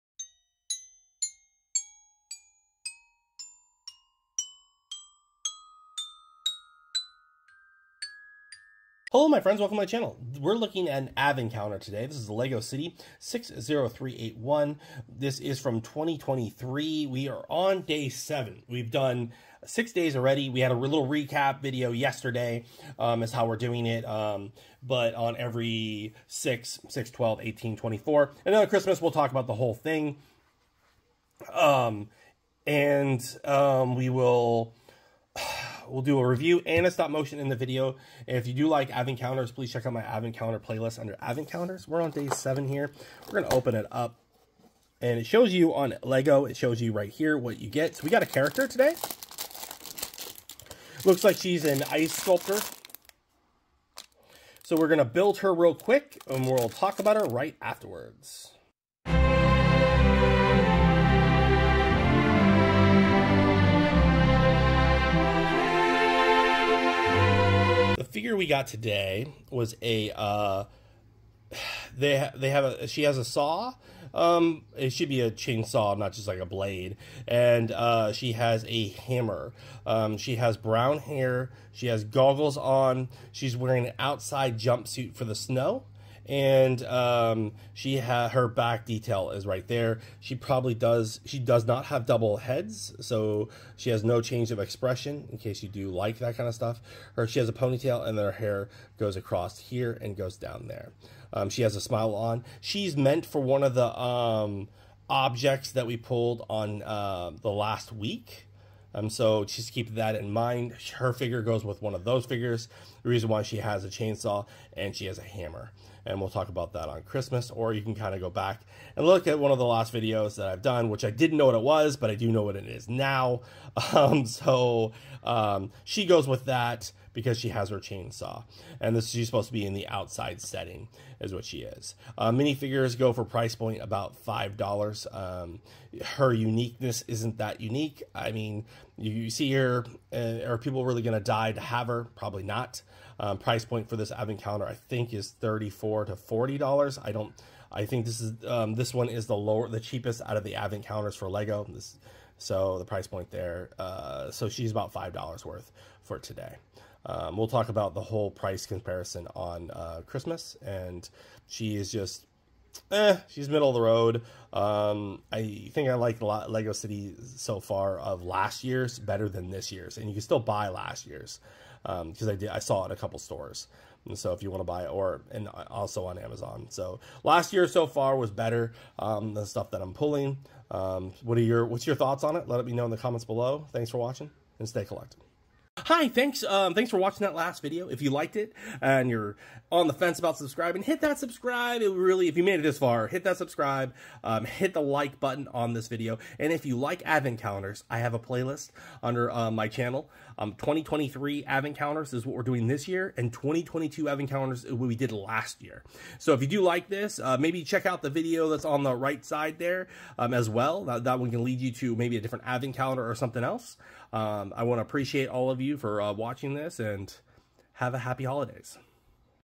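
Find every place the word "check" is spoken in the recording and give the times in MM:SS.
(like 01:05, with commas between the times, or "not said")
00:39, 03:27.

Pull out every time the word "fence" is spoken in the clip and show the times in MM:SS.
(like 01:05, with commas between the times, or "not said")
03:09.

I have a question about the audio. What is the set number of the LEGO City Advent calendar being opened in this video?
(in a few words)
60381.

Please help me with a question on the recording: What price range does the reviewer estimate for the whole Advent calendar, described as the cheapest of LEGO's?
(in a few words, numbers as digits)
$34 to $40.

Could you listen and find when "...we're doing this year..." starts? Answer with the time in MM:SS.
03:22.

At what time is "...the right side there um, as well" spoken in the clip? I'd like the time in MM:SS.
03:28.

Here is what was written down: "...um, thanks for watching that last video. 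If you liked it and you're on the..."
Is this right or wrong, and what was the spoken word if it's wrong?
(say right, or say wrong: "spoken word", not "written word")
right.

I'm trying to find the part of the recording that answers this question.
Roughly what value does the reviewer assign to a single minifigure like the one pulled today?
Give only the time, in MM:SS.
02:14.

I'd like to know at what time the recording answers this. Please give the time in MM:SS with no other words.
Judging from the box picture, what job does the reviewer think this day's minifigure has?
00:51.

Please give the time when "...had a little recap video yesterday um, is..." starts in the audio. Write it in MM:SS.
00:20.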